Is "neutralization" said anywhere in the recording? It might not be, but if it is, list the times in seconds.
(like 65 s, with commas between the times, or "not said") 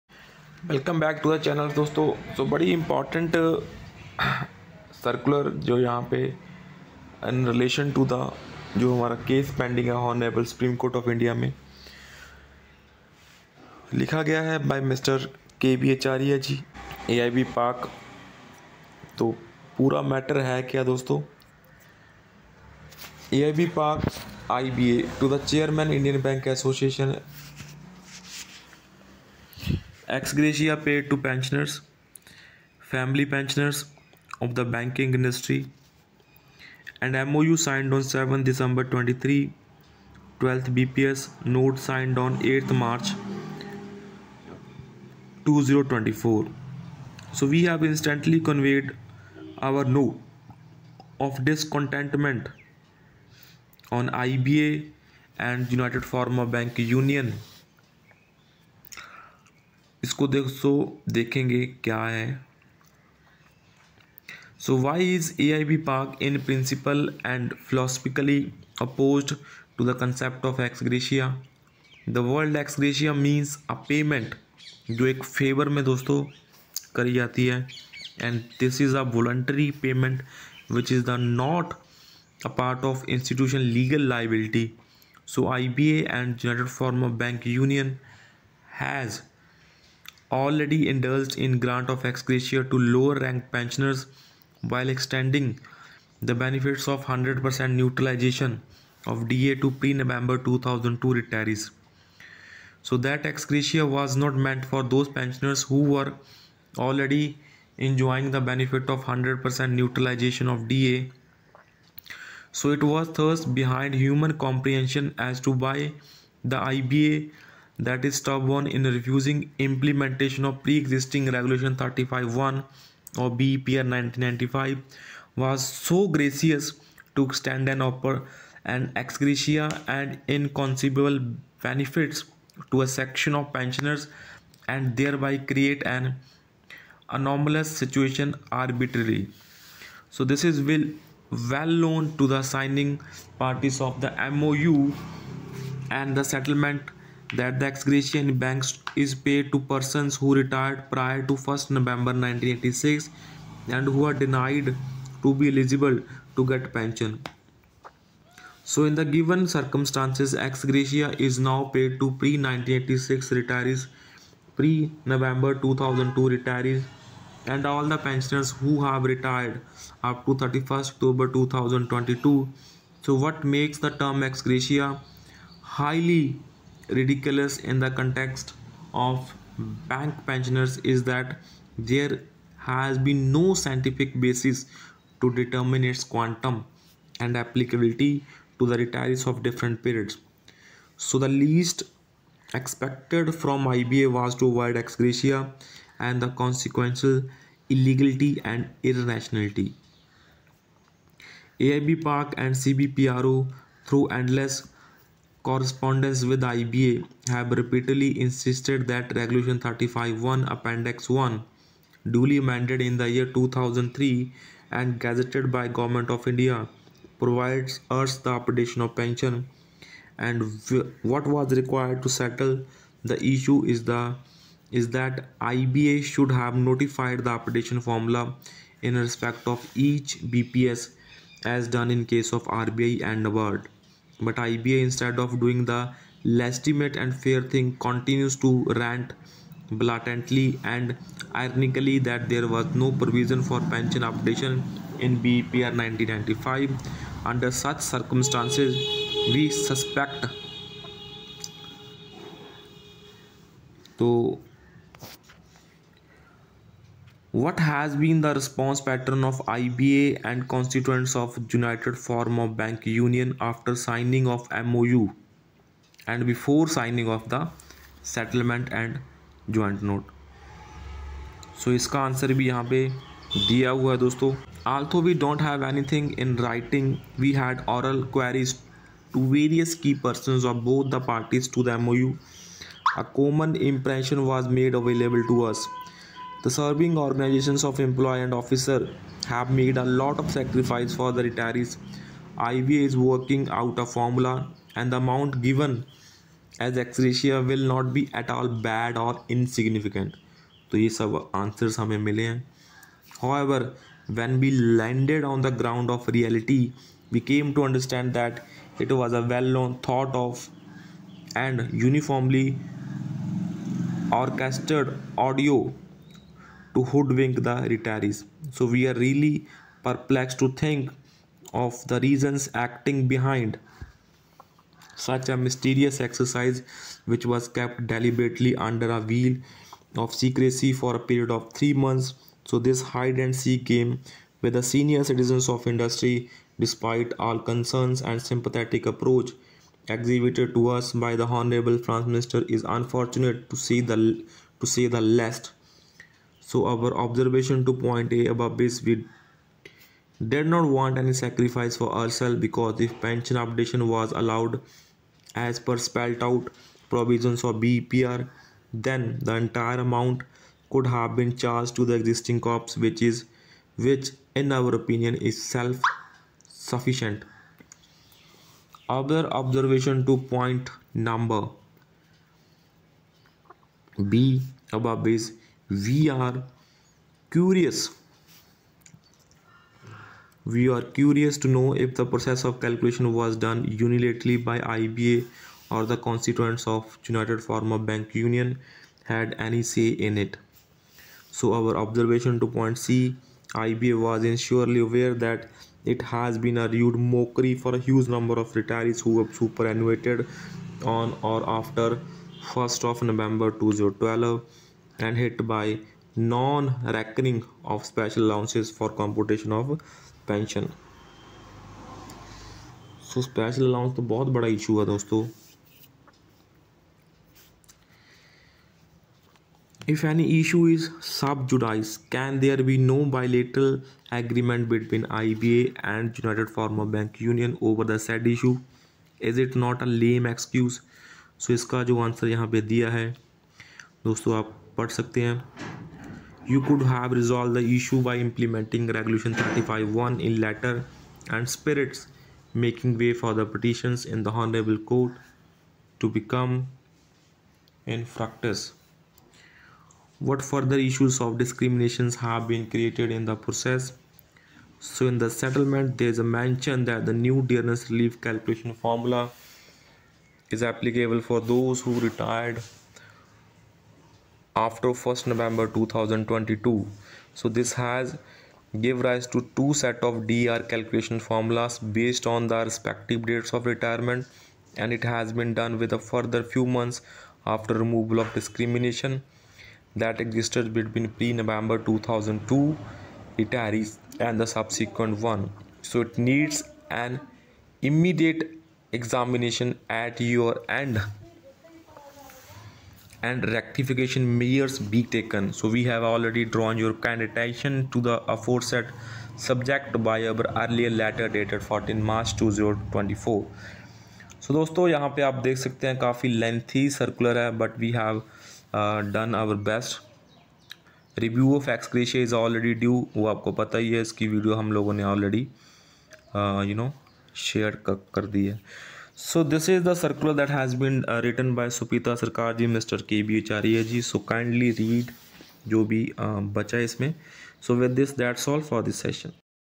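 97 s, 109 s.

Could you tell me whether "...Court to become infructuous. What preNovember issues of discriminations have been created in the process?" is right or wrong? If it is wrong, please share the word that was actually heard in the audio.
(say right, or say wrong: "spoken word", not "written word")
wrong: "further", not "preNovember".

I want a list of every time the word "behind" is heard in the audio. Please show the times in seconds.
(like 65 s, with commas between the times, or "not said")
113 s, 323 s.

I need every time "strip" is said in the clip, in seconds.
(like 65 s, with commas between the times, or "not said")
not said.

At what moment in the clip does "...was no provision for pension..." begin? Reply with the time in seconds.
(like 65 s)
242 s.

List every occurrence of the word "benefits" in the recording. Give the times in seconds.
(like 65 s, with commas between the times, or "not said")
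96 s, 108 s, 131 s.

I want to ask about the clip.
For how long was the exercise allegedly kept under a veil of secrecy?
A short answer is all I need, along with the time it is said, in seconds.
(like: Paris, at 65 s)
3 months, at 331 s.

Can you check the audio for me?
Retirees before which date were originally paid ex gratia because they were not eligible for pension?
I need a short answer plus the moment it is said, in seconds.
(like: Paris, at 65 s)
1 November 1986, at 151 s.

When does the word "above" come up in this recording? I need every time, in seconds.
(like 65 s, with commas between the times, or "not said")
348 s, 374 s.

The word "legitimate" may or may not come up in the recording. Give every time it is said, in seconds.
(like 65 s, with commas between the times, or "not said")
236 s.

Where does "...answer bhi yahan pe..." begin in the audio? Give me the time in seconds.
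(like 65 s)
272 s.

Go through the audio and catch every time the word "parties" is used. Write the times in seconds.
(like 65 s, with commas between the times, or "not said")
143 s, 280 s.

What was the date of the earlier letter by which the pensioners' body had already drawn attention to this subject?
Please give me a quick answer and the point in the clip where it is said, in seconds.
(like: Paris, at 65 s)
14 March 2024, at 501 s.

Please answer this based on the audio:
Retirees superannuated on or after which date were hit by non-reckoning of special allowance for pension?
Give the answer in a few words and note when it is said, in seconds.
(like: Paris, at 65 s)
1 November 2012, at 402 s.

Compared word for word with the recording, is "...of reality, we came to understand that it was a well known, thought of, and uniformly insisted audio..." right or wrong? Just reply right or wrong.
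wrong.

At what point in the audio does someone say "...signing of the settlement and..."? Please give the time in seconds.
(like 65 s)
266 s.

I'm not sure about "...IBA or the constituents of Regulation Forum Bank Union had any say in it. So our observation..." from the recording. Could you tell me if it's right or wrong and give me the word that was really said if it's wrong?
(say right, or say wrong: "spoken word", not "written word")
wrong: "United", not "Regulation".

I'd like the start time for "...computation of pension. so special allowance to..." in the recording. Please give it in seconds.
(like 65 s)
408 s.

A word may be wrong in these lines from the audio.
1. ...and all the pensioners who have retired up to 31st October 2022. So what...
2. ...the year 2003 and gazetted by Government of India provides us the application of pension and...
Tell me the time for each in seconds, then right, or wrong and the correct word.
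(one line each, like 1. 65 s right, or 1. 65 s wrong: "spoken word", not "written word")
1. 167 s right
2. 212 s right.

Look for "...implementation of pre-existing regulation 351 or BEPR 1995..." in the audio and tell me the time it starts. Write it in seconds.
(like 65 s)
119 s.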